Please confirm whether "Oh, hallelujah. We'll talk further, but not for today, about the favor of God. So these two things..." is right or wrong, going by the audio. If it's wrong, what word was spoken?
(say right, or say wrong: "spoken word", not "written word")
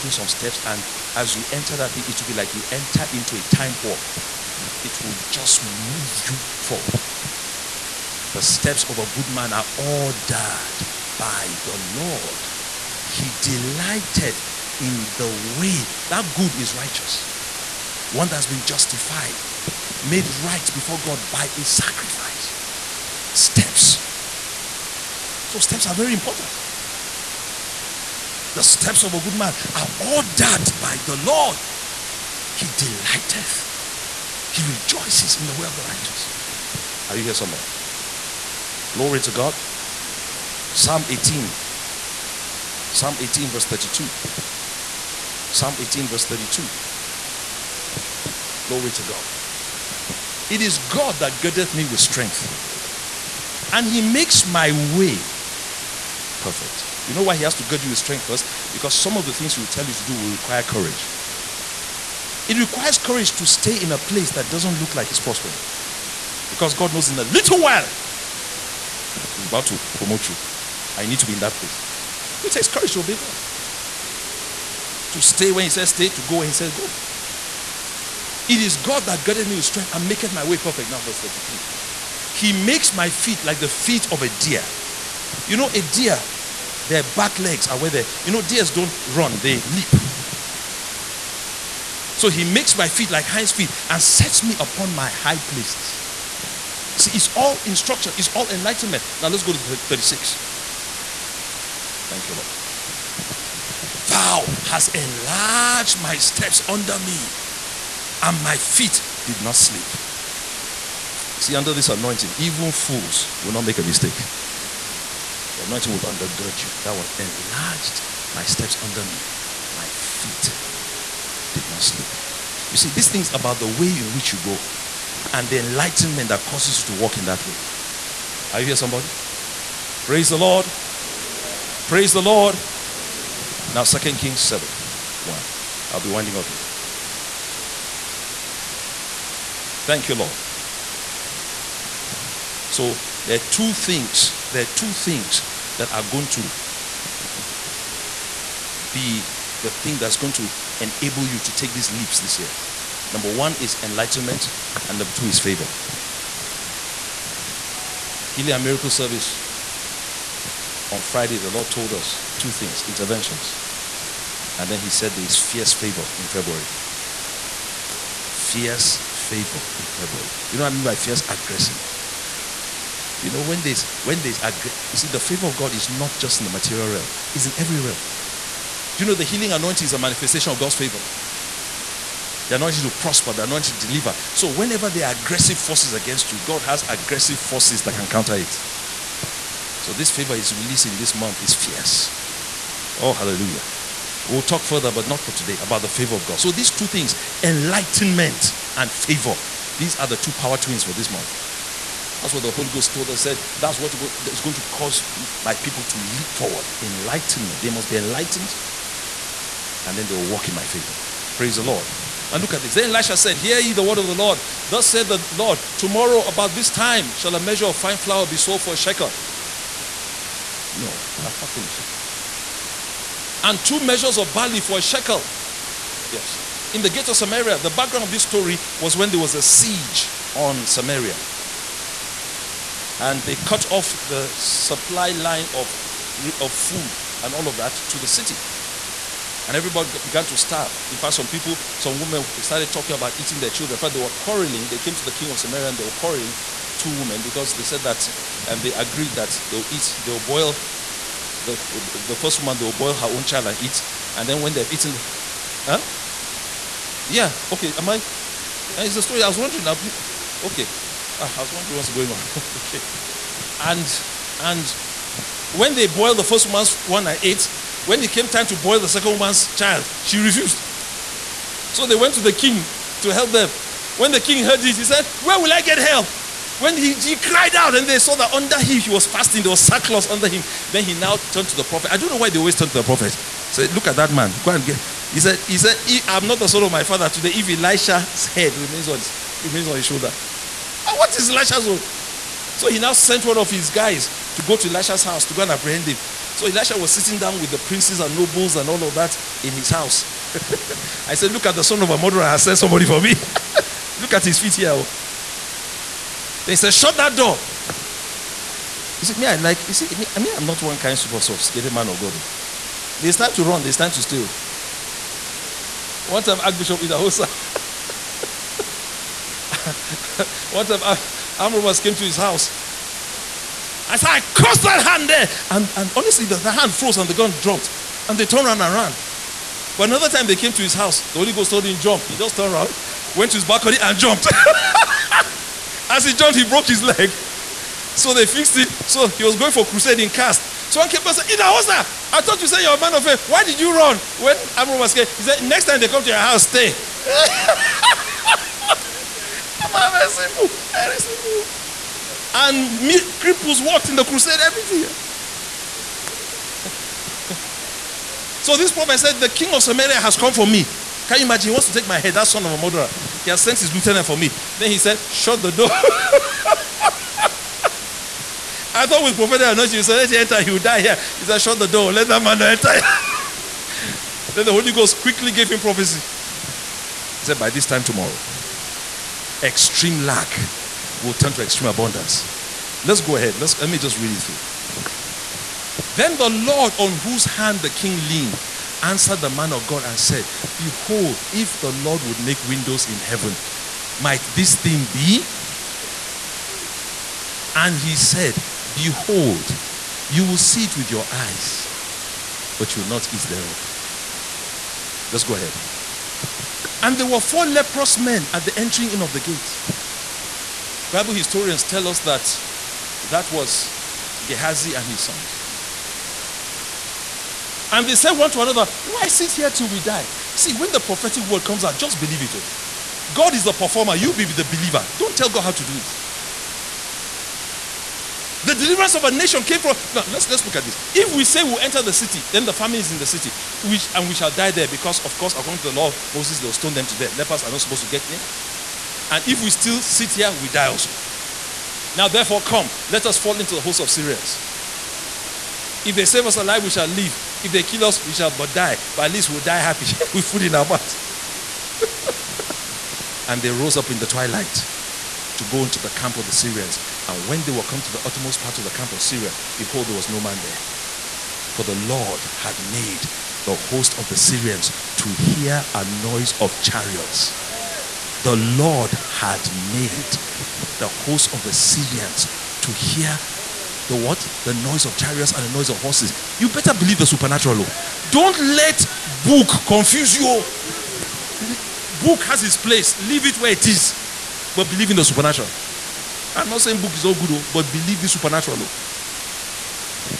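right.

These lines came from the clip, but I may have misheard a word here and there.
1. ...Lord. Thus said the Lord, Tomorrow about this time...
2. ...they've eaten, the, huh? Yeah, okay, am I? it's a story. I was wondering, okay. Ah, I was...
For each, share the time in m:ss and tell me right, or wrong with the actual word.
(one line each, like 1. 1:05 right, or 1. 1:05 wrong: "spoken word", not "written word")
1. 3:34 right
2. 4:14 right.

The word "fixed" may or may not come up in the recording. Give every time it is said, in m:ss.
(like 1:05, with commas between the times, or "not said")
5:38.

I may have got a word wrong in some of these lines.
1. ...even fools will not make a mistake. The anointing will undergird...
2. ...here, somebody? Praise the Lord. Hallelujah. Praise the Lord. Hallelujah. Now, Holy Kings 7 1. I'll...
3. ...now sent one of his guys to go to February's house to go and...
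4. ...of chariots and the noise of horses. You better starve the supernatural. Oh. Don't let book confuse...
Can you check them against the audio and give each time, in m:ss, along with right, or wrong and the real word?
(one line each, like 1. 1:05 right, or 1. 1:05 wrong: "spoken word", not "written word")
1. 1:52 right
2. 2:08 wrong: "Second", not "Holy"
3. 4:52 wrong: "Elisha", not "February"
4. 7:54 wrong: "believe", not "starve".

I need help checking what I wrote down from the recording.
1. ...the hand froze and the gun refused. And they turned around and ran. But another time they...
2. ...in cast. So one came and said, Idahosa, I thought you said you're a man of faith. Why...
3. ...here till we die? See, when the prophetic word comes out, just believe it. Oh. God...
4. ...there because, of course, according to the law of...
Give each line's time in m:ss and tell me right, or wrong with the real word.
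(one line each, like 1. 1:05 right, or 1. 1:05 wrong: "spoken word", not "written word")
1. 5:26 wrong: "dropped", not "refused"
2. 5:40 right
3. 6:59 right
4. 7:14 right.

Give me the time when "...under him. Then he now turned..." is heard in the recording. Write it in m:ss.
4:40.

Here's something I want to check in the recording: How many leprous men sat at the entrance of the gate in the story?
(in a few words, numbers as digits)
4.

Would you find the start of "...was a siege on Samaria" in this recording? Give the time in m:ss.
3:49.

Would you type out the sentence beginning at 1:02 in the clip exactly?
It requires courage to stay in a place that doesn't look like it's prospering.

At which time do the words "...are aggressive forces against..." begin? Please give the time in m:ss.
3:05.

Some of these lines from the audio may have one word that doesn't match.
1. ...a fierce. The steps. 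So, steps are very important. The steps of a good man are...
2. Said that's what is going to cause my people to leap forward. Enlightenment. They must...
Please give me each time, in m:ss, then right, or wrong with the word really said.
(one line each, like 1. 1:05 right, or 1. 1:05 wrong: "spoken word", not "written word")
1. 0:21 wrong: "sacrifice", not "fierce"
2. 3:23 right.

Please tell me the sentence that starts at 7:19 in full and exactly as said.
And if we still sit here, we die also.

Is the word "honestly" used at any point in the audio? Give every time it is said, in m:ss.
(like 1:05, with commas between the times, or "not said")
5:25.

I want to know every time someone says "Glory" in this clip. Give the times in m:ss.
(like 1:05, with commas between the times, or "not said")
0:38, 0:48.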